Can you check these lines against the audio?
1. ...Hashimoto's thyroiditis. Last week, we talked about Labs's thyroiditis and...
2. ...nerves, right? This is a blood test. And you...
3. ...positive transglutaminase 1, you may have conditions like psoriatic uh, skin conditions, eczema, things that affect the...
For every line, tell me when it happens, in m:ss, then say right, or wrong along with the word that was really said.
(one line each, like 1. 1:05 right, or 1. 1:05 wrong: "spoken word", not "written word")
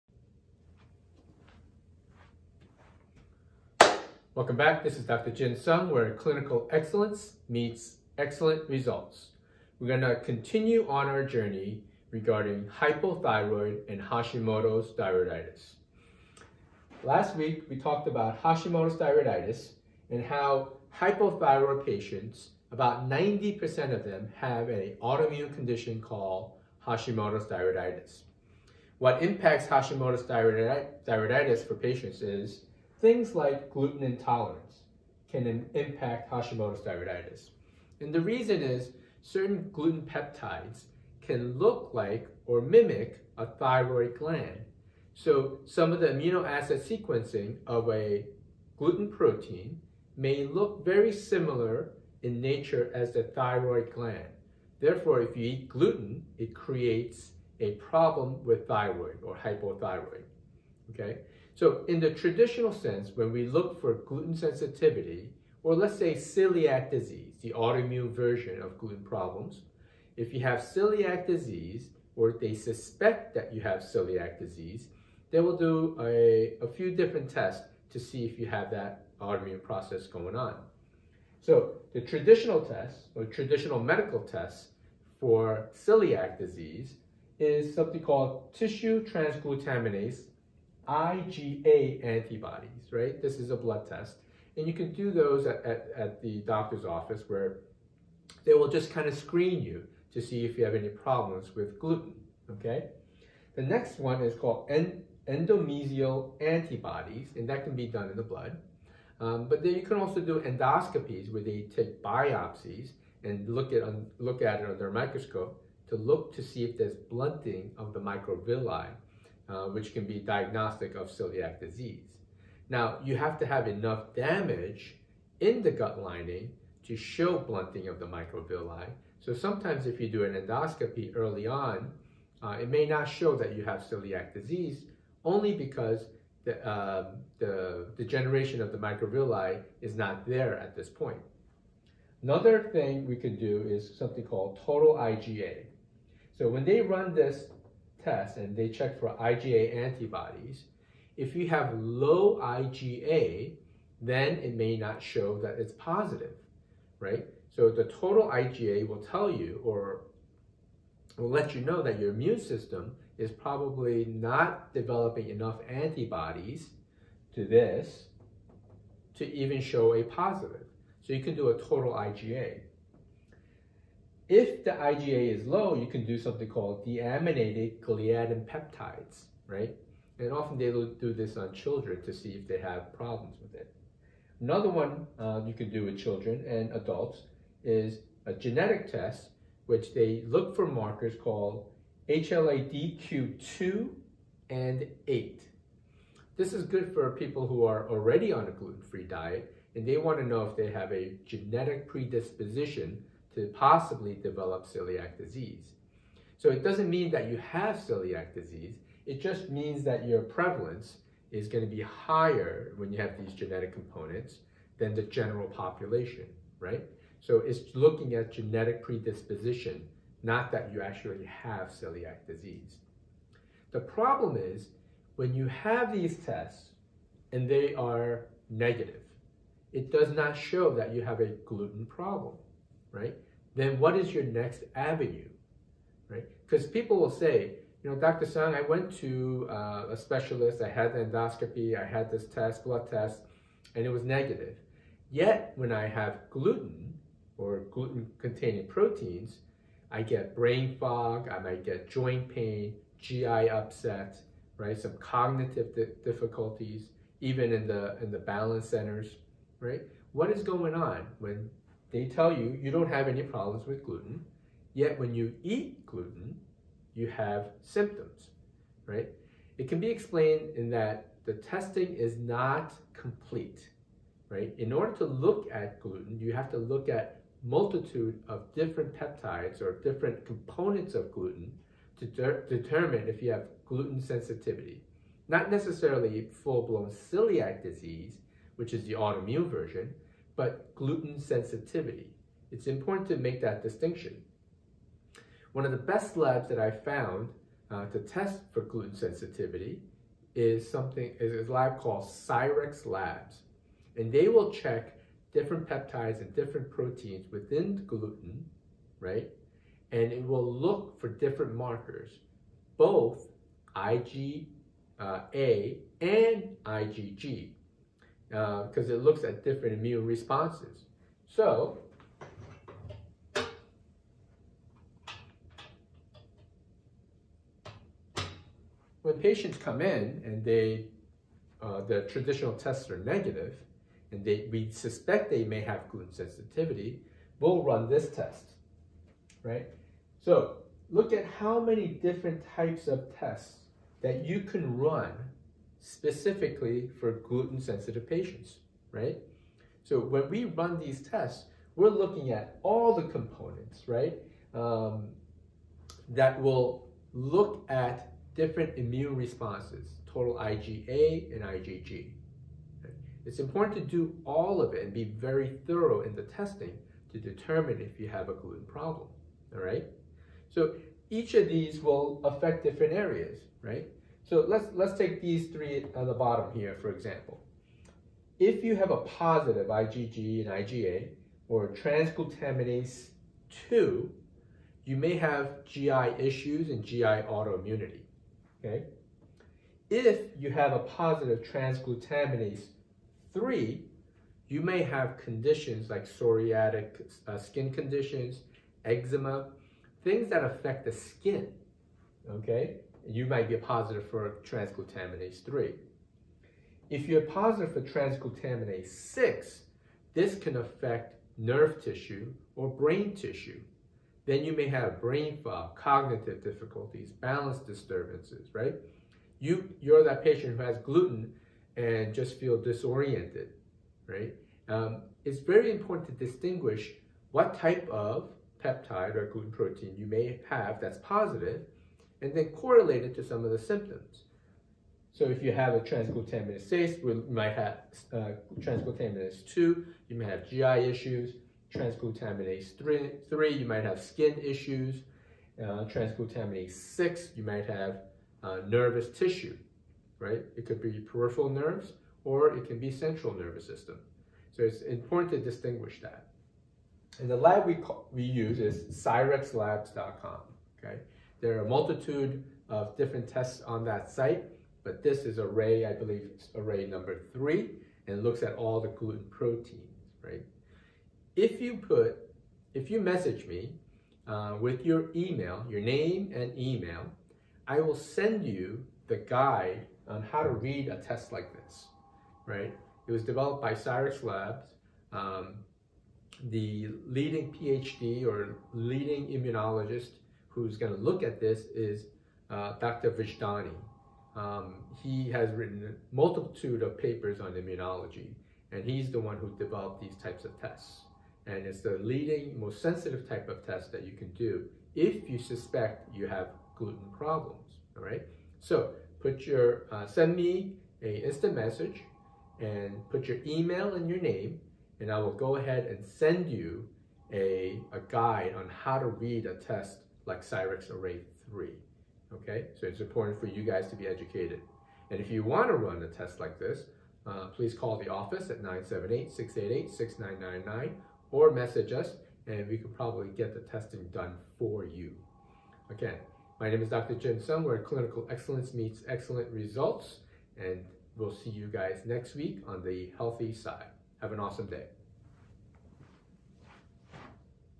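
1. 0:14 wrong: "Hashimoto", not "Labs"
2. 1:32 wrong: "antibodies", not "nerves"
3. 6:30 wrong: "3", not "1".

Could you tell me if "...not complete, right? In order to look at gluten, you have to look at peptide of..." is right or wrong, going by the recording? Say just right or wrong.
wrong.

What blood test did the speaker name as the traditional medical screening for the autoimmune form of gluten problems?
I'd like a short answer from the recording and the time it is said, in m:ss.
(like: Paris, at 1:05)
Tissue transglutaminase IgA antibodies, at 1:28.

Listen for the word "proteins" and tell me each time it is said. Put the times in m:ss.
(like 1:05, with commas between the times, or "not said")
0:49, 4:08, 5:06, 7:09, 7:49.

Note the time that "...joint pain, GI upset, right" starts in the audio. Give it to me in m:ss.
4:11.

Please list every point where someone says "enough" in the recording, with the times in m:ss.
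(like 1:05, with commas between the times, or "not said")
2:03, 2:45.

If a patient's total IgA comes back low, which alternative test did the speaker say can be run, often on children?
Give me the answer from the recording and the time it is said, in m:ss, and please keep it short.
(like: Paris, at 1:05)
Deaminated gliadin peptides, at 2:56.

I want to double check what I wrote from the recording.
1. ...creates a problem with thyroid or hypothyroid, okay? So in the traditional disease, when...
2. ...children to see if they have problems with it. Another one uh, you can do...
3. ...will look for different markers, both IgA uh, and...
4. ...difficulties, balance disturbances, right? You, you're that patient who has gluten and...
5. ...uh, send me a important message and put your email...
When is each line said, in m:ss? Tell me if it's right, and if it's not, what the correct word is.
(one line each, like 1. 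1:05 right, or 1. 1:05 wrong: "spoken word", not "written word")
1. 0:56 wrong: "sense", not "disease"
2. 3:01 right
3. 5:10 right
4. 6:56 right
5. 8:29 wrong: "instant", not "important".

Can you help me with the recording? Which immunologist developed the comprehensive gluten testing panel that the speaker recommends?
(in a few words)
Dr. Vojdani.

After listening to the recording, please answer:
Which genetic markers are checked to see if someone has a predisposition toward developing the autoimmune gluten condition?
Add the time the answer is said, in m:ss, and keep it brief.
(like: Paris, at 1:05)
HLA-DQ2 and 8, at 3:12.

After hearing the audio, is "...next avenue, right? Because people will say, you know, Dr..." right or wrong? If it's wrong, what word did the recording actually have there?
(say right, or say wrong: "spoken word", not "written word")
right.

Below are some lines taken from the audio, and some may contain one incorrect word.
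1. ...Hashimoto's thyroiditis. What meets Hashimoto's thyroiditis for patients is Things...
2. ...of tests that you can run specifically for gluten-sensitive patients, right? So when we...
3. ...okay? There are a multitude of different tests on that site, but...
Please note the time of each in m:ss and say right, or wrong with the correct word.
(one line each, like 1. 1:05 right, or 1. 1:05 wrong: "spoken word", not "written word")
1. 0:26 wrong: "impacts", not "meets"
2. 5:42 right
3. 7:40 right.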